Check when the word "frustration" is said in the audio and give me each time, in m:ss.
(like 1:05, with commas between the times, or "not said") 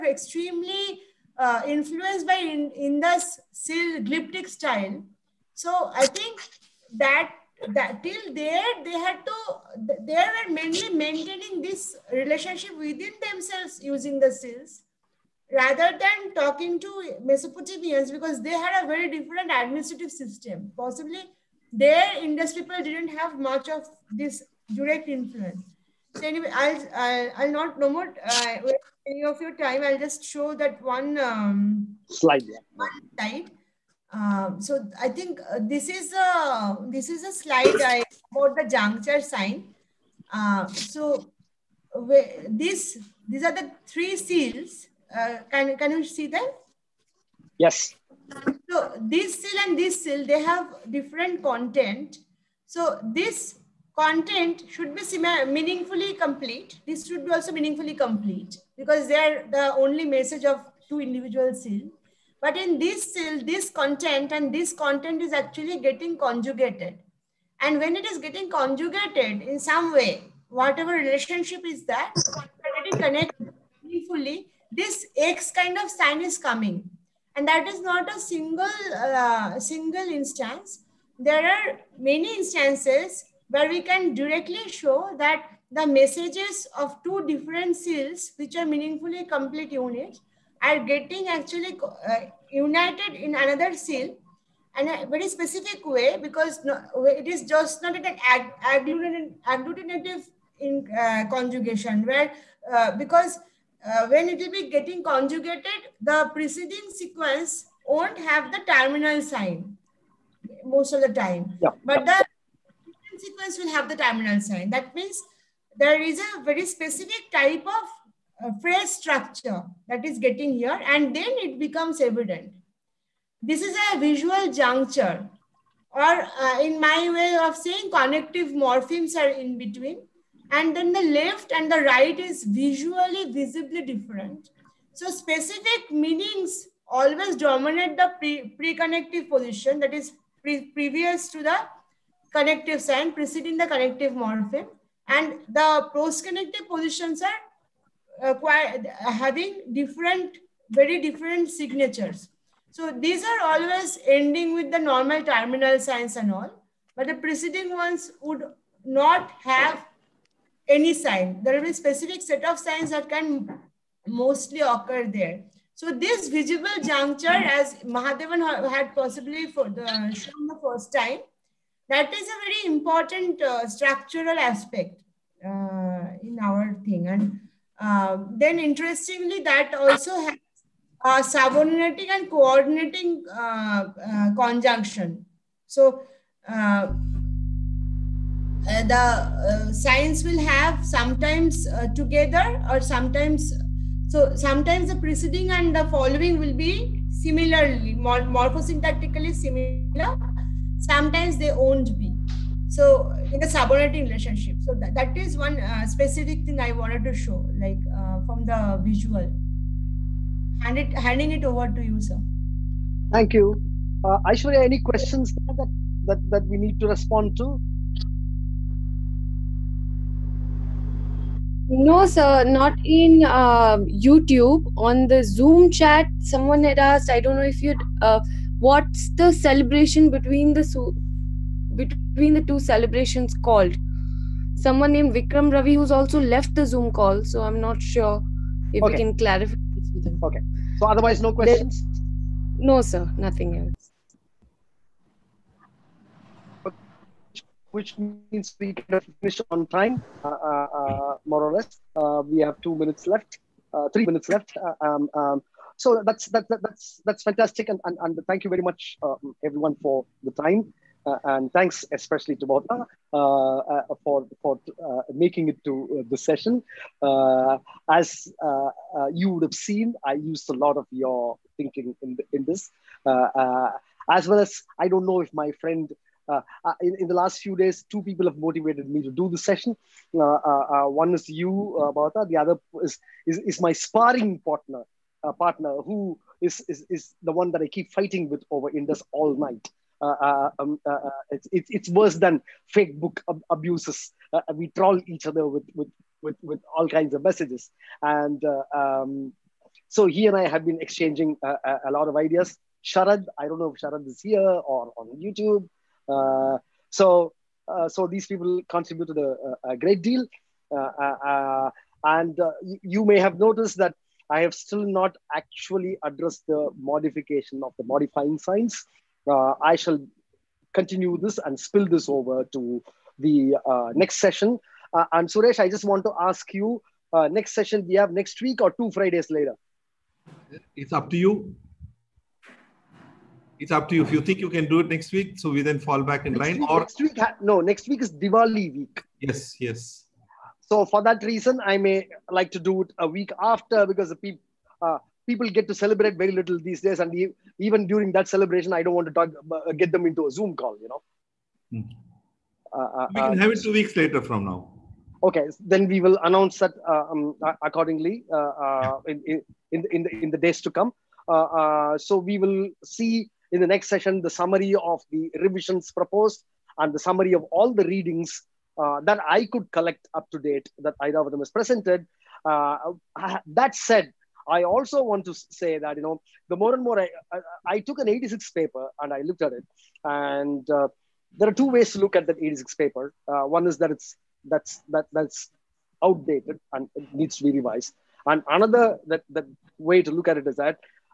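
not said.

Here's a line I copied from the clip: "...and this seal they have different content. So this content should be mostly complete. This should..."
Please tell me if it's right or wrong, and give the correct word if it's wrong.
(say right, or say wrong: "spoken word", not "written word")
wrong: "meaningfully", not "mostly".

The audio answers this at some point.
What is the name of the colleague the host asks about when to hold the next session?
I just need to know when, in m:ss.
5:25.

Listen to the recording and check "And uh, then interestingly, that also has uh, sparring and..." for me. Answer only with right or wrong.
wrong.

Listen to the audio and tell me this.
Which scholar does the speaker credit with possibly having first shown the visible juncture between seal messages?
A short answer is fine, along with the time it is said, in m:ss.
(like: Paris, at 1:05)
Mahadevan, at 2:47.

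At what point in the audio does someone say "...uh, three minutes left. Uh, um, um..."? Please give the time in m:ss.
4:13.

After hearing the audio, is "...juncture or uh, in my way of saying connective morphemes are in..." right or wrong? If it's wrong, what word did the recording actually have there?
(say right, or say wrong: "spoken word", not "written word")
right.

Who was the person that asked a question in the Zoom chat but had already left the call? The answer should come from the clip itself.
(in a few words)
Vikram Ravi.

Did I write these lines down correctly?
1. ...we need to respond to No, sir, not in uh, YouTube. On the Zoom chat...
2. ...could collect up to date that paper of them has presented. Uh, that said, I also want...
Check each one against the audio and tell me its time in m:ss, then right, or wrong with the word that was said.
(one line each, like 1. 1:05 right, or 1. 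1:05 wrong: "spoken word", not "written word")
1. 3:36 right
2. 6:09 wrong: "either", not "paper".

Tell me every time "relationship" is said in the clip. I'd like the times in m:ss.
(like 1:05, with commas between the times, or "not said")
0:12, 1:10, 3:24.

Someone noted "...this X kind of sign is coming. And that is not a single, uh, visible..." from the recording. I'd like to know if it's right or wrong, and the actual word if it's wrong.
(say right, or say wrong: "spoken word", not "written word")
wrong: "single", not "visible".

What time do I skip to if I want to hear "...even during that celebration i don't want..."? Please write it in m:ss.
5:47.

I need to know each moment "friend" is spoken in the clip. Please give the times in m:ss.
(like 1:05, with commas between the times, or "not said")
4:35.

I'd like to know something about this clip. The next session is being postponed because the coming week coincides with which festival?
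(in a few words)
Diwali.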